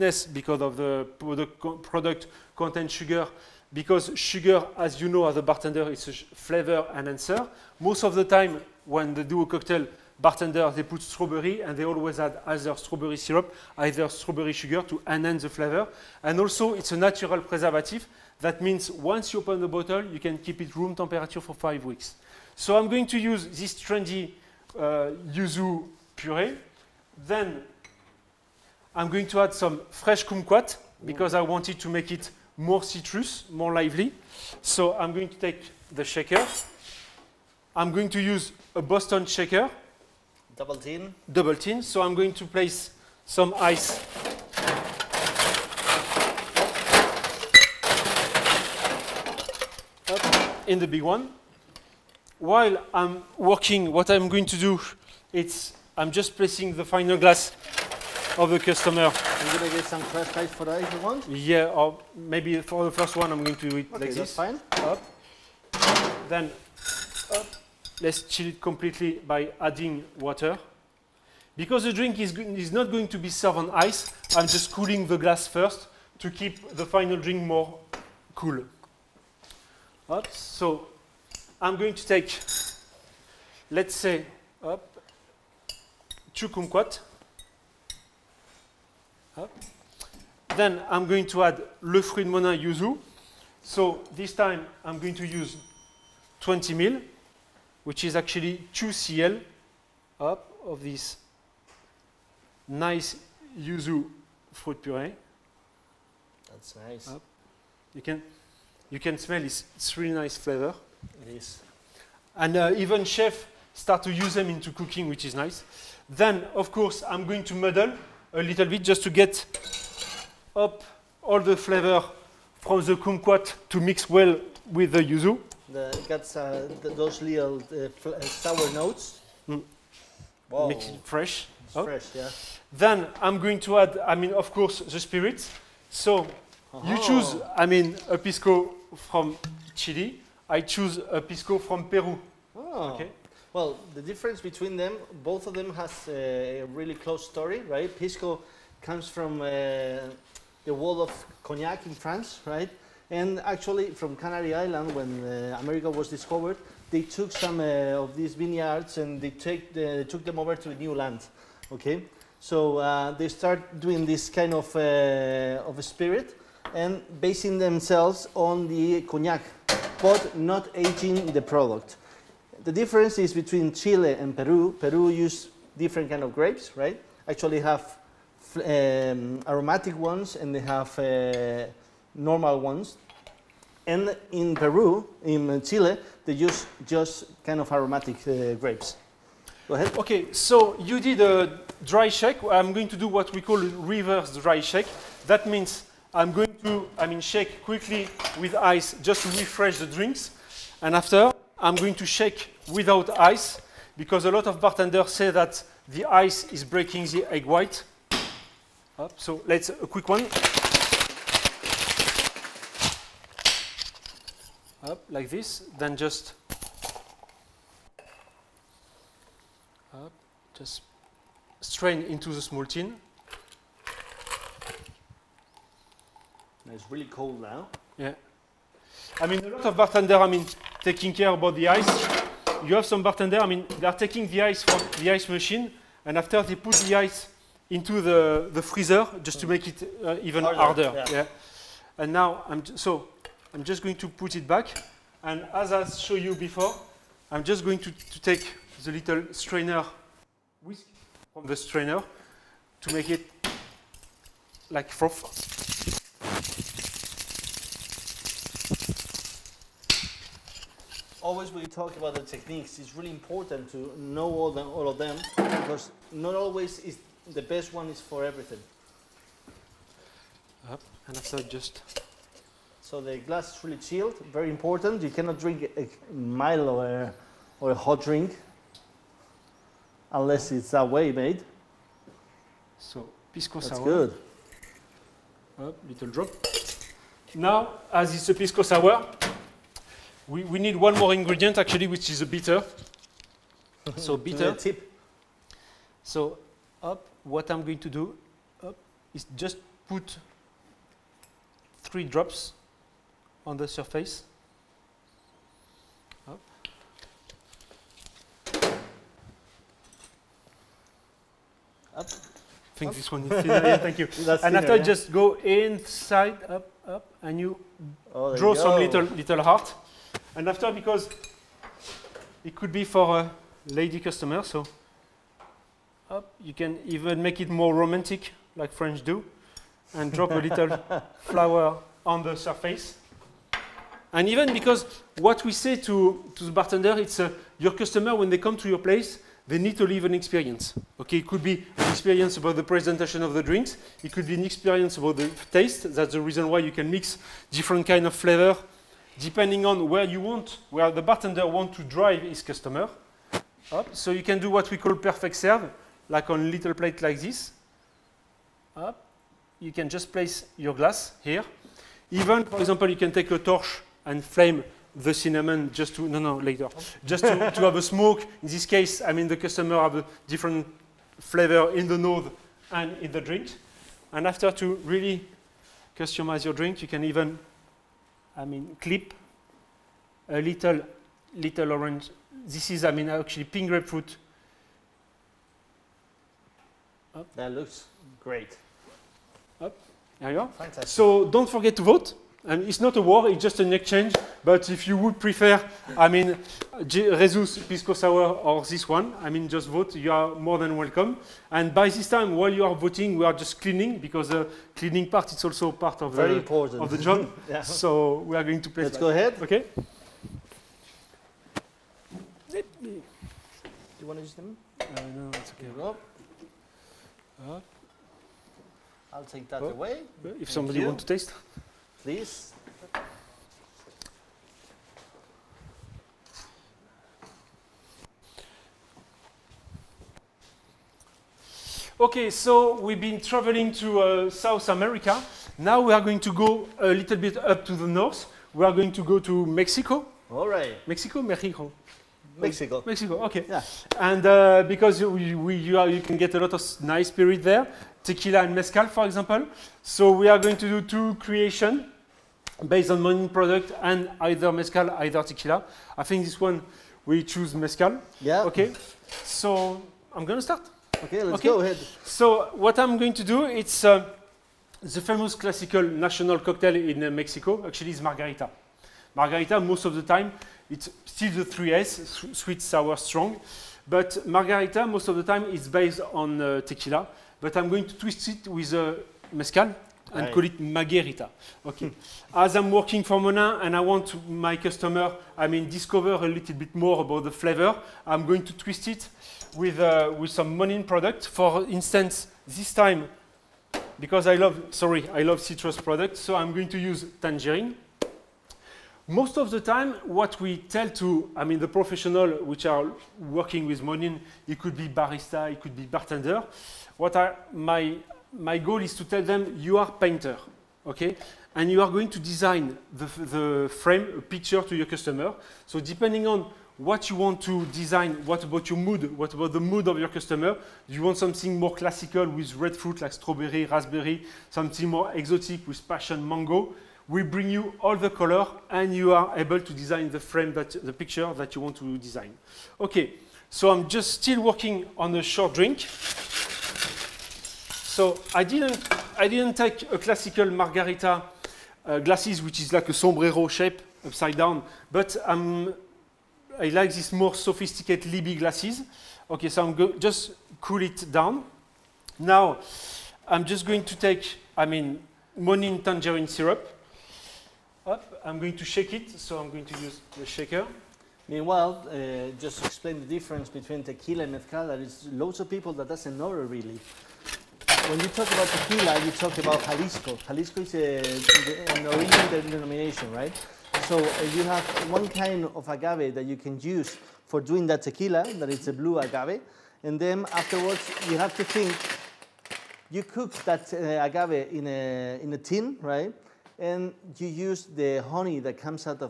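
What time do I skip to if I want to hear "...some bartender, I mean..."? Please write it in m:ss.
3:52.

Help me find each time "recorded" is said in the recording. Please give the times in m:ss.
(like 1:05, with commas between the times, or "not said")
not said.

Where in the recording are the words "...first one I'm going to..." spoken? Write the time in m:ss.
1:02.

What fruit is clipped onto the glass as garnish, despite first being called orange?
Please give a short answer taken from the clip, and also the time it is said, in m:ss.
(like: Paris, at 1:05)
pink grapefruit, at 6:23.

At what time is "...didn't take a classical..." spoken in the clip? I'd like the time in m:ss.
8:59.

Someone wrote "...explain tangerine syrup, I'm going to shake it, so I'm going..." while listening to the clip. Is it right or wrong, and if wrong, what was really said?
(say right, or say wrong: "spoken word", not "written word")
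wrong: "monin", not "explain".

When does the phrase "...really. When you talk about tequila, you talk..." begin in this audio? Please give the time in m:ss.
9:26.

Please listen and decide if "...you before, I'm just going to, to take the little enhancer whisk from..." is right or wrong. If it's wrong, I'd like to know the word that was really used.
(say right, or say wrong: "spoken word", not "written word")
wrong: "strainer", not "enhancer".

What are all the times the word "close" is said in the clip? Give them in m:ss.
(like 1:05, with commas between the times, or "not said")
2:26.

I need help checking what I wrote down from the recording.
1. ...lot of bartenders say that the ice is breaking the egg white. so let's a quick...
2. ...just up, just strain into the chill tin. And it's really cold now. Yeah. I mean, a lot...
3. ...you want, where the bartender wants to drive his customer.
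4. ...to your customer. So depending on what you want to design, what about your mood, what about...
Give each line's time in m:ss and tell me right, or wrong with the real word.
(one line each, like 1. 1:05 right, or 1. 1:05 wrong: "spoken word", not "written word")
1. 3:24 right
2. 3:35 wrong: "small", not "chill"
3. 5:50 right
4. 8:34 right.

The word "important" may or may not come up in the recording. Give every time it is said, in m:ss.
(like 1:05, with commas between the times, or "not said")
4:23, 4:34, 6:46.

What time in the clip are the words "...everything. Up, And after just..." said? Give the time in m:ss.
4:28.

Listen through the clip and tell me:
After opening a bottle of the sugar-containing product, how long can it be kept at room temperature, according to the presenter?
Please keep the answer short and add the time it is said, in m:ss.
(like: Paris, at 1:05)
5 weeks, at 0:21.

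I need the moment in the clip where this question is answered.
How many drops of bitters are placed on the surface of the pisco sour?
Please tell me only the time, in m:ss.
5:01.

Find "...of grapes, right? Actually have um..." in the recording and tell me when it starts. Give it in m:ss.
2:56.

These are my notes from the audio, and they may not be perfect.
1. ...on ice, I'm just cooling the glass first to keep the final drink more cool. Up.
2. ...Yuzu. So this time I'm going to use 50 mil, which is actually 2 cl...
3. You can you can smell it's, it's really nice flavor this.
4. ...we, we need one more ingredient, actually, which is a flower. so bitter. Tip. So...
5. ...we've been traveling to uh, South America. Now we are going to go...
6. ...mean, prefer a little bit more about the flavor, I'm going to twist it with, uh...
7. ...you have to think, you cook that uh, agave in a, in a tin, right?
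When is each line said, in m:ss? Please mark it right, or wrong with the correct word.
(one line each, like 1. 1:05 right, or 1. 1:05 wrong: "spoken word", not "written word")
1. 1:13 right
2. 1:32 wrong: "20", not "50"
3. 1:47 right
4. 4:50 wrong: "bitter", not "flower"
5. 7:12 right
6. 8:05 wrong: "discover", not "prefer"
7. 9:41 right.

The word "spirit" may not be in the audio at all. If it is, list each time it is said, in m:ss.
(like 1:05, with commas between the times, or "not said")
2:14, 2:45, 7:27.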